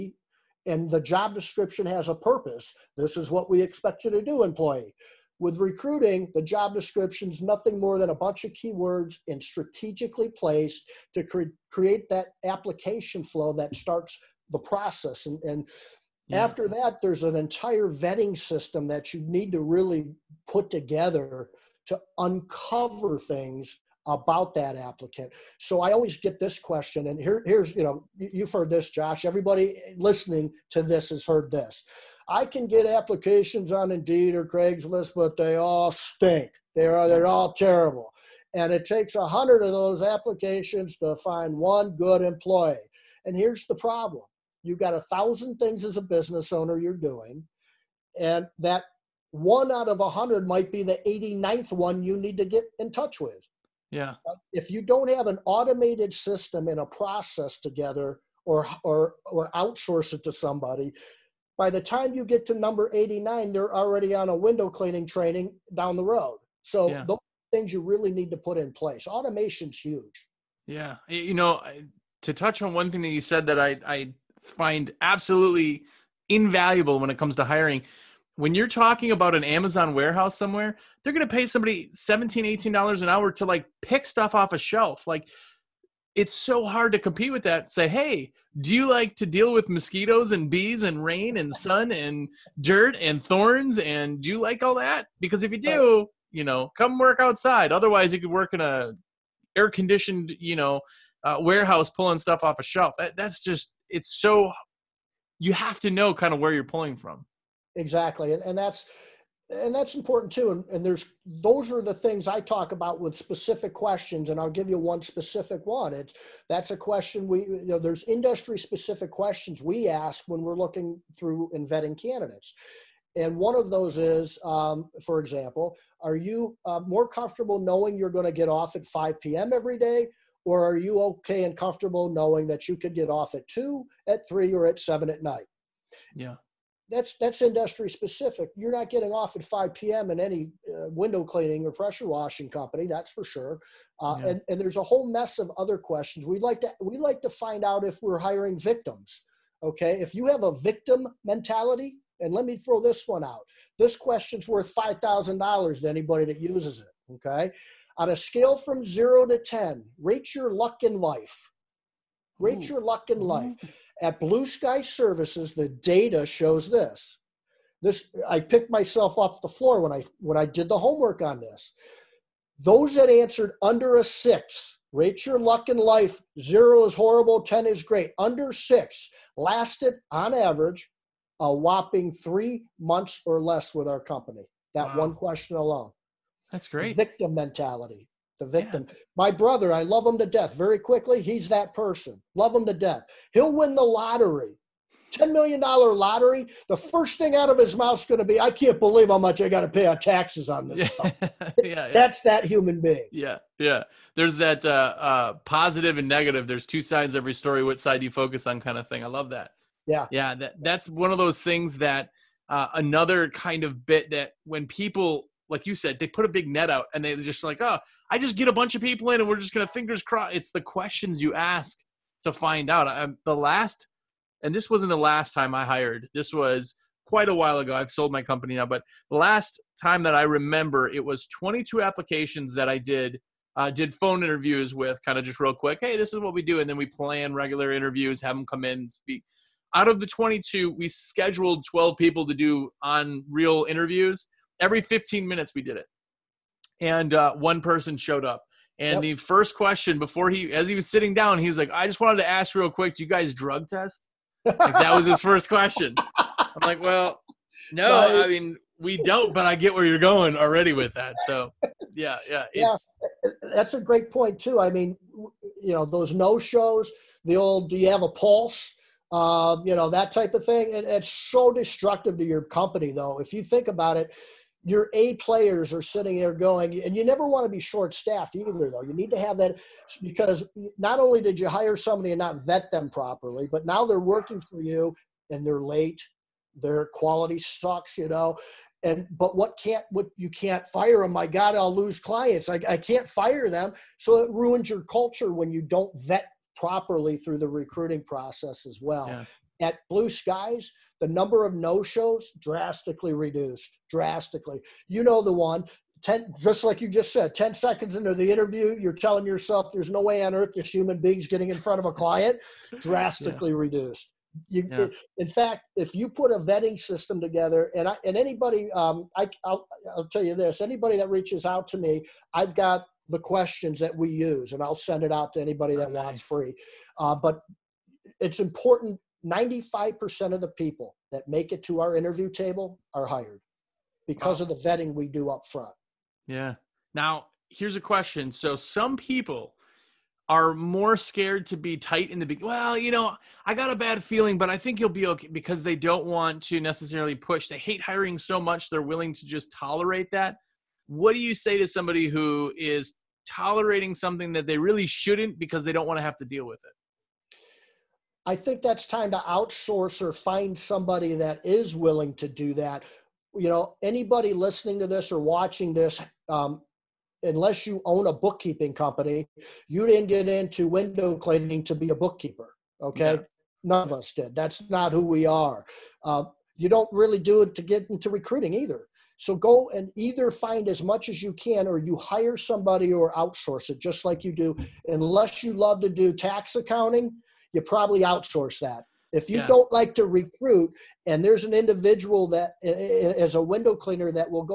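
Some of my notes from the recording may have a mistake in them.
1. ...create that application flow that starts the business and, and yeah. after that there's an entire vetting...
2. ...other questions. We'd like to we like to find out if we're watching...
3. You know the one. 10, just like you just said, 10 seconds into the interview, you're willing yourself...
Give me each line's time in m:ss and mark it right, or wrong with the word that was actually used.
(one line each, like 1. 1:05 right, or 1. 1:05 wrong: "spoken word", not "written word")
1. 0:11 wrong: "process", not "business"
2. 2:25 wrong: "hiring", not "watching"
3. 5:04 wrong: "telling", not "willing".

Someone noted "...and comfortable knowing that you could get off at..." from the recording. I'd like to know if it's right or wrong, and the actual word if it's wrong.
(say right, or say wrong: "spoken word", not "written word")
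right.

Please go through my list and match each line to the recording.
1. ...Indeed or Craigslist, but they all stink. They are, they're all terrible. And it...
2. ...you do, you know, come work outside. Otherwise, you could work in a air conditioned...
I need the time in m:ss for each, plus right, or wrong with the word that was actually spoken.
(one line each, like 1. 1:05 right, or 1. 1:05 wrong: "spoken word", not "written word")
1. 0:33 right
2. 1:35 right.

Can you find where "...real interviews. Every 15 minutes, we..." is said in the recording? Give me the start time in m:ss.
4:03.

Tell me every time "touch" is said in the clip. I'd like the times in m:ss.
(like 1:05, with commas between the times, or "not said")
0:52, 1:12.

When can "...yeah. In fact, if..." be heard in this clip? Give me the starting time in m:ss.
5:14.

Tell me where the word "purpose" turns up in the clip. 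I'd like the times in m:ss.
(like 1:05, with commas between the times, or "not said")
0:02.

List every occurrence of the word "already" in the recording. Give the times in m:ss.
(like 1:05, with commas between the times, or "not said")
1:03, 4:20.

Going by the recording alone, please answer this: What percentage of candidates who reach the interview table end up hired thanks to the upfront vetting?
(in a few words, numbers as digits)
95%.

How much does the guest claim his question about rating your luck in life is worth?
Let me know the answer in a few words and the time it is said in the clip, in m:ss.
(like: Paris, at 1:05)
$5,000, at 2:34.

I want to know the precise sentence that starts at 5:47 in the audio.
They hate hiring so much, they're willing to just tolerate that.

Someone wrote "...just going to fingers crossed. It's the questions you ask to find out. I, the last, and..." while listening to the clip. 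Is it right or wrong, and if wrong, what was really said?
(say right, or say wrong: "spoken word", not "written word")
right.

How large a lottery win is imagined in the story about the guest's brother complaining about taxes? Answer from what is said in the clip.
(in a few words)
$10 million.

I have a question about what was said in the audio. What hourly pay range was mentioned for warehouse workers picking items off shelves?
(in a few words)
$17-18.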